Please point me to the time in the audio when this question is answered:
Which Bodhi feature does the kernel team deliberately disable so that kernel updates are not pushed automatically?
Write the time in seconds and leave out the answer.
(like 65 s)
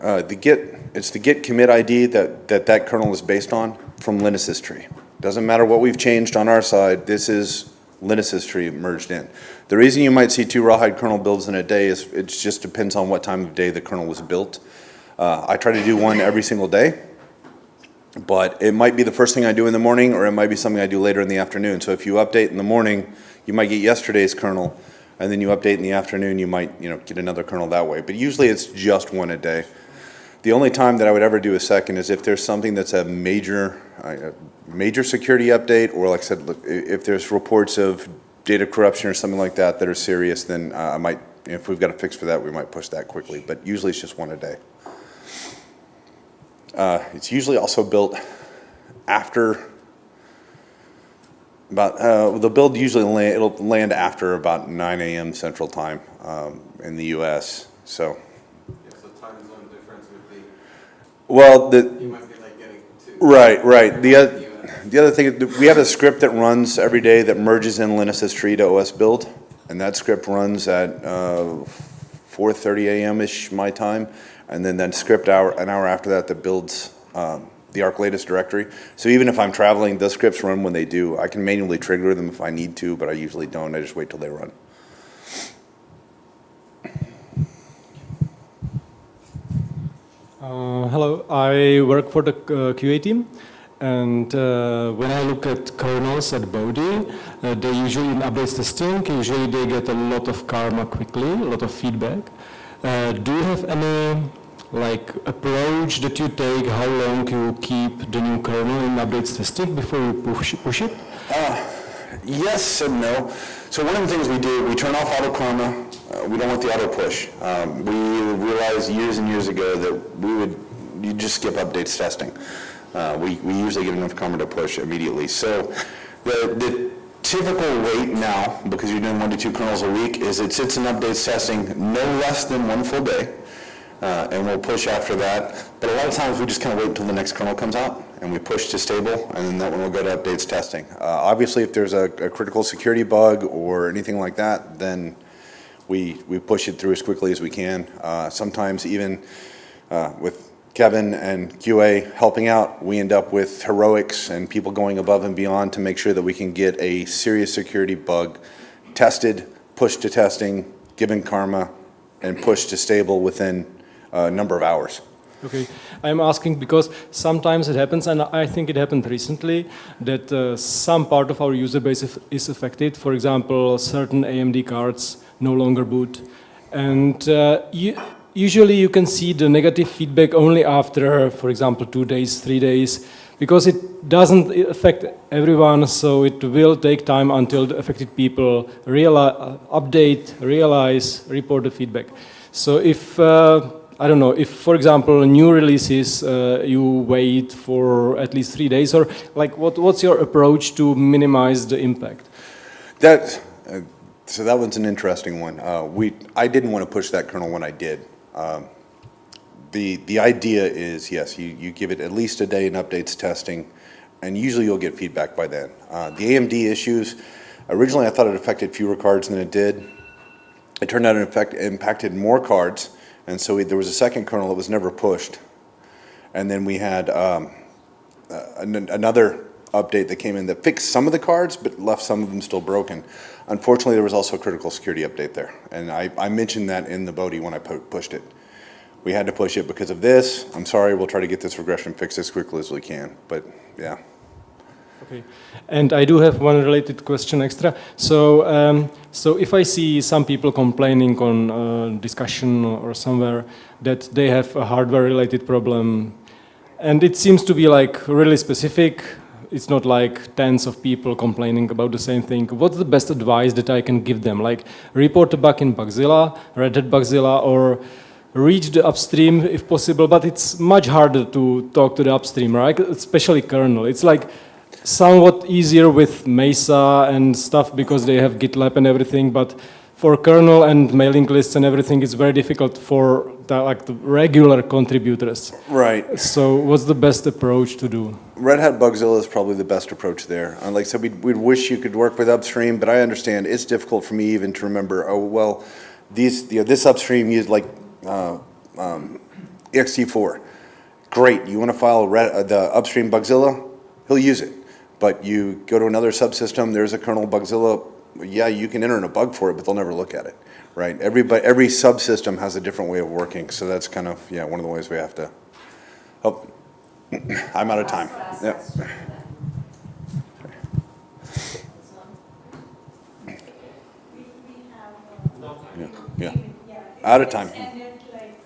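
115 s.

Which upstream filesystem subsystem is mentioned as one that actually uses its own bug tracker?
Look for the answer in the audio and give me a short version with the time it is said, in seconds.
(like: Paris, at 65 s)
ext4, at 299 s.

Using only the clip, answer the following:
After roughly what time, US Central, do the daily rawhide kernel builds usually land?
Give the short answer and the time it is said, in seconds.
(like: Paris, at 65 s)
9 a.m., at 54 s.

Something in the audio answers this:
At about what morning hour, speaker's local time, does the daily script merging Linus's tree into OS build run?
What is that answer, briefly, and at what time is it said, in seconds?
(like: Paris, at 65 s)
4:30 a.m., at 72 s.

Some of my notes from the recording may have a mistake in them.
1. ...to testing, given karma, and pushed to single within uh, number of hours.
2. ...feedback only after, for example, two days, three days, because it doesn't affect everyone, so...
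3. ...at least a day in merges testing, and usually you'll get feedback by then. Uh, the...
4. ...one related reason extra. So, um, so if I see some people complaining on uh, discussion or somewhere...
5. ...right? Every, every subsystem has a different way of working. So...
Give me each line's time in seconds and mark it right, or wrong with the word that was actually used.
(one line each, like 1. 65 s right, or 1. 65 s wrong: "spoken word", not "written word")
1. 160 s wrong: "stable", not "single"
2. 179 s right
3. 212 s wrong: "updates", not "merges"
4. 246 s wrong: "question", not "reason"
5. 310 s right.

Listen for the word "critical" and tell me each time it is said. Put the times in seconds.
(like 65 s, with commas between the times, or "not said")
142 s, 234 s.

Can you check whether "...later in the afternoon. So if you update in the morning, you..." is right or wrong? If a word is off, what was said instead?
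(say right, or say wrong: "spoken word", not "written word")
right.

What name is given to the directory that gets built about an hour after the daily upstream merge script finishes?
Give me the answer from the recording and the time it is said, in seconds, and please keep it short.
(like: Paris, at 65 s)
ark-latest, at 77 s.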